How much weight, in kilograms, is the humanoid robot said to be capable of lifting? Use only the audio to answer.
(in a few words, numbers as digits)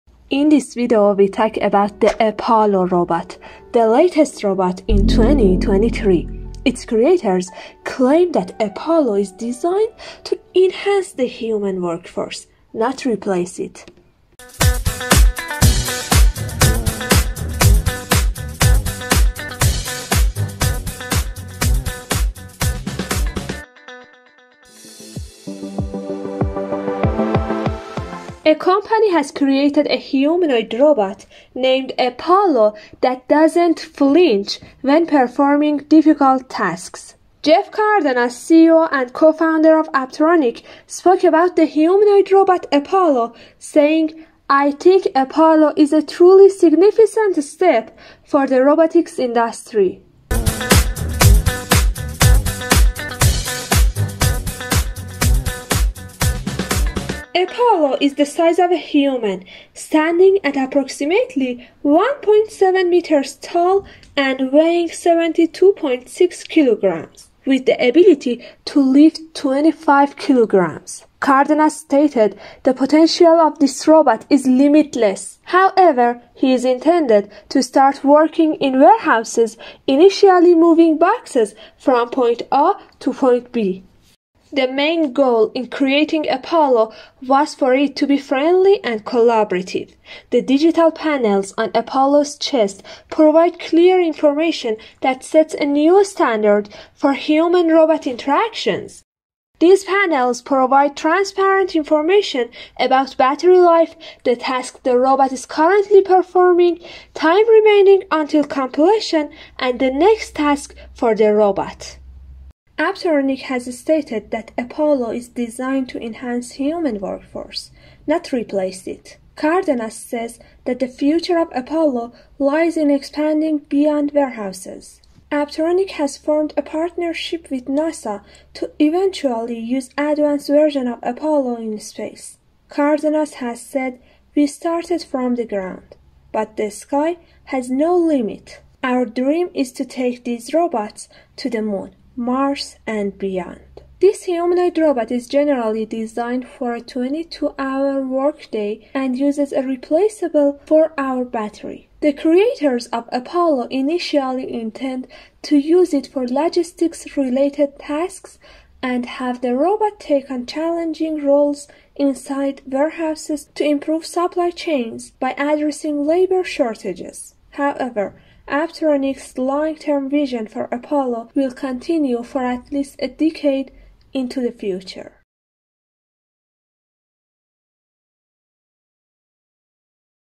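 25 kilograms.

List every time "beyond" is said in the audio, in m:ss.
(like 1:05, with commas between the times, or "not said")
2:03, 2:23.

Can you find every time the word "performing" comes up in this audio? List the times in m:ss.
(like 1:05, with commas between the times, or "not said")
0:35, 1:46.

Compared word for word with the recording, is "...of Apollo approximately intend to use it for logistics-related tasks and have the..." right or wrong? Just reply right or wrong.
wrong.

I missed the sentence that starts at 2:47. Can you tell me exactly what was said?
However, Apptronik's long-term vision for Apollo will continue for at least a decade into the future.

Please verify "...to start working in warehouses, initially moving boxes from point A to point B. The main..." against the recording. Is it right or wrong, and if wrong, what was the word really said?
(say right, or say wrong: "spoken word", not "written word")
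right.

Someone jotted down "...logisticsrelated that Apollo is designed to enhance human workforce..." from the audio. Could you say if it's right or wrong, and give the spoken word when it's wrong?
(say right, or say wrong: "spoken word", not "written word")
wrong: "stated", not "logisticsrelated".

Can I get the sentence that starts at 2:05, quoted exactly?
Apptronik has formed a partnership with NASA to eventually use advanced version of Apollo in space.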